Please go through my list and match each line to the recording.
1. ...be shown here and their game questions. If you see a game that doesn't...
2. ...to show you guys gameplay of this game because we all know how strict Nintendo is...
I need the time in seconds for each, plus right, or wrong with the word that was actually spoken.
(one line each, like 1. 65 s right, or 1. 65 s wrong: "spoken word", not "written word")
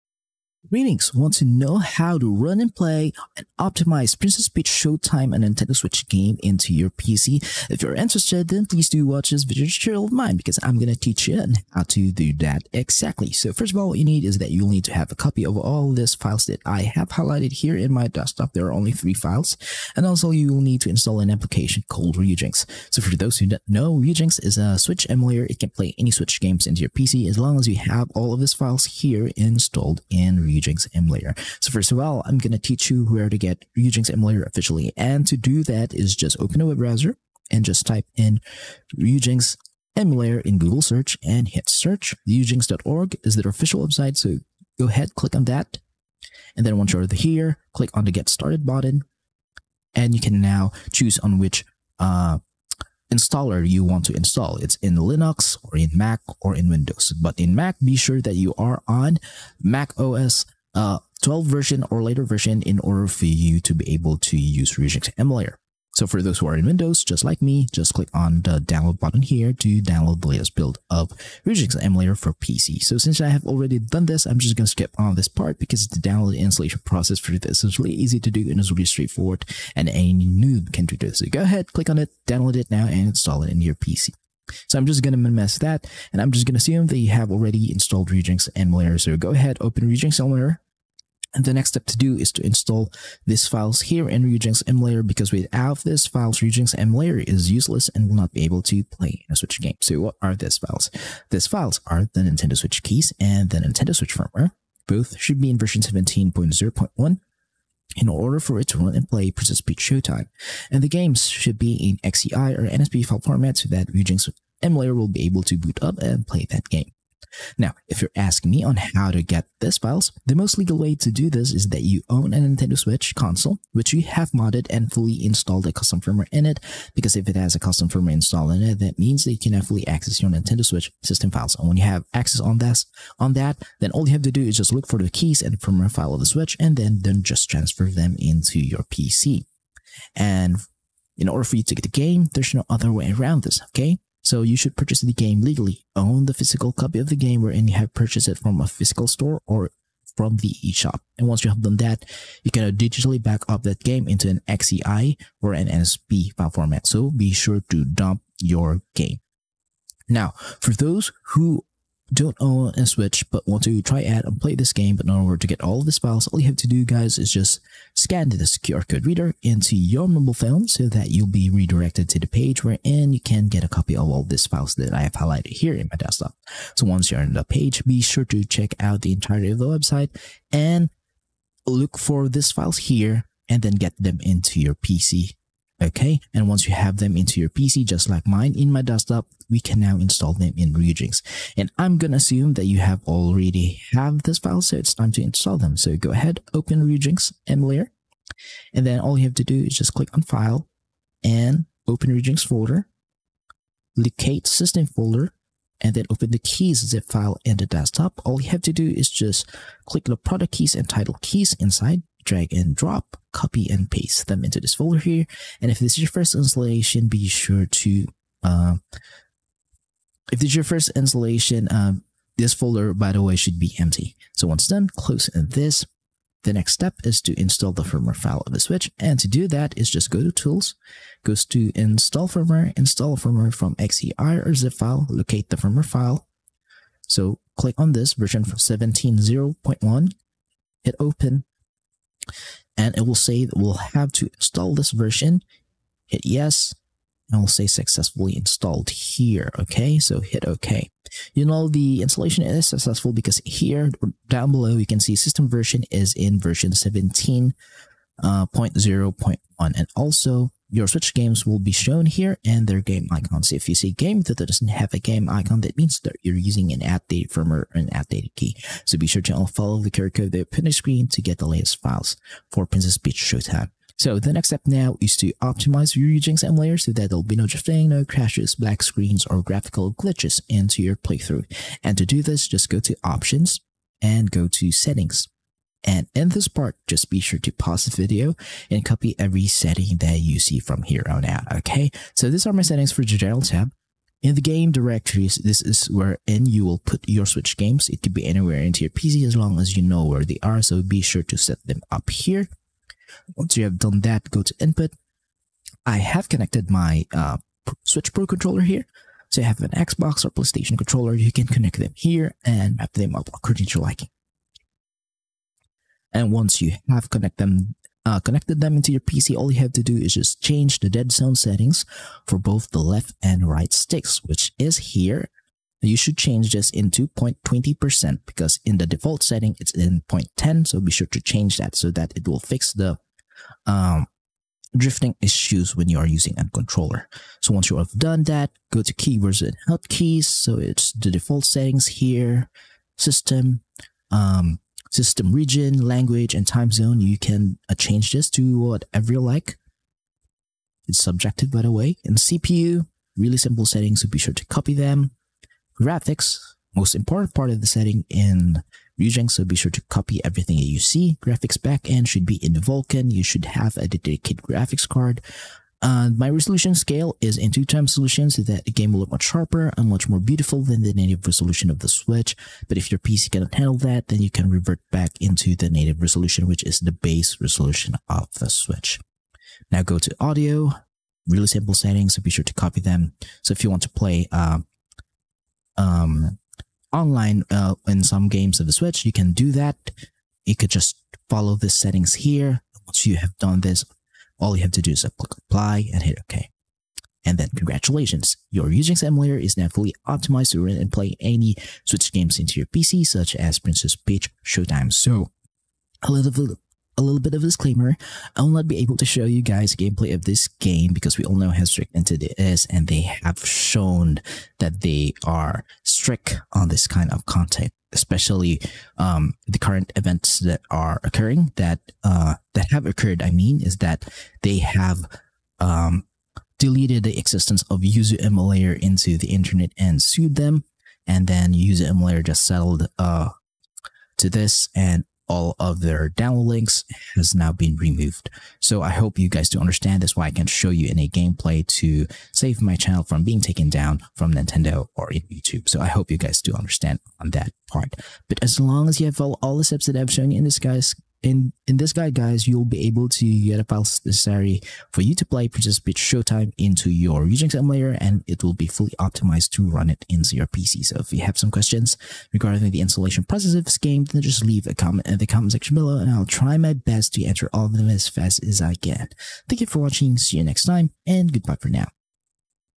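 1. 261 s wrong: "icons", not "questions"
2. 408 s right.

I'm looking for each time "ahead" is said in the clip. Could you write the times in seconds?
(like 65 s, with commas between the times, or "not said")
44 s, 81 s, 89 s, 196 s.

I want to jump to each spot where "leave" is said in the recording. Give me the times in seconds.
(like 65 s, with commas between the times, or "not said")
464 s.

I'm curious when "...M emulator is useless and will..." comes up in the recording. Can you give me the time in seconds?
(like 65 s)
96 s.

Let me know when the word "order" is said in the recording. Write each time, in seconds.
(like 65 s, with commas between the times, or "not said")
62 s, 108 s, 141 s, 165 s.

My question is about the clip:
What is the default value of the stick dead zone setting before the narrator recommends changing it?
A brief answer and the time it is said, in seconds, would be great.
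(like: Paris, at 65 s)
0.10, at 330 s.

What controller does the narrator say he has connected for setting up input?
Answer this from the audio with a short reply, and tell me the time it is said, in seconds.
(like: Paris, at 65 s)
Switch Pro controller, at 307 s.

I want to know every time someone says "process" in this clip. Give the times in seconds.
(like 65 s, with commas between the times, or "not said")
76 s, 463 s.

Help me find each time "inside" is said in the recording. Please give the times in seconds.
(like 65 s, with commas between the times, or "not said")
211 s.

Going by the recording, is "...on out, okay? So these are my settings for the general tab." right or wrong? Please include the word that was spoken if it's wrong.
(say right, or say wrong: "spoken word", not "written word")
right.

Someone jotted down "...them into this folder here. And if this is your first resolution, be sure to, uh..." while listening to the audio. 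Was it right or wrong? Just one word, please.
wrong.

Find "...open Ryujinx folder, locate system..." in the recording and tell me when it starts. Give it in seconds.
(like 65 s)
201 s.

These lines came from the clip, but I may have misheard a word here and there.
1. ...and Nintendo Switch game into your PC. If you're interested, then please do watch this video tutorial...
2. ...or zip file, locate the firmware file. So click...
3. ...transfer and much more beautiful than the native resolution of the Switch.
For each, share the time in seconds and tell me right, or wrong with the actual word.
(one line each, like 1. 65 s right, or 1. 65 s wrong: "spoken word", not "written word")
1. 5 s right
2. 234 s right
3. 369 s wrong: "sharper", not "transfer".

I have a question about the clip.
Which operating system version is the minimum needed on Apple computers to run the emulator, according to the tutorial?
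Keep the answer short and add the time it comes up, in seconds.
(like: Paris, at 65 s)
macOS 12, at 61 s.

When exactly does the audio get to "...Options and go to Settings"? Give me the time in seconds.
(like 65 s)
283 s.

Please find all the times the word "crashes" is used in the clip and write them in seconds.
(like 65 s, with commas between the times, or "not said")
278 s.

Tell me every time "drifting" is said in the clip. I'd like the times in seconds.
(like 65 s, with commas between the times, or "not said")
277 s, 334 s.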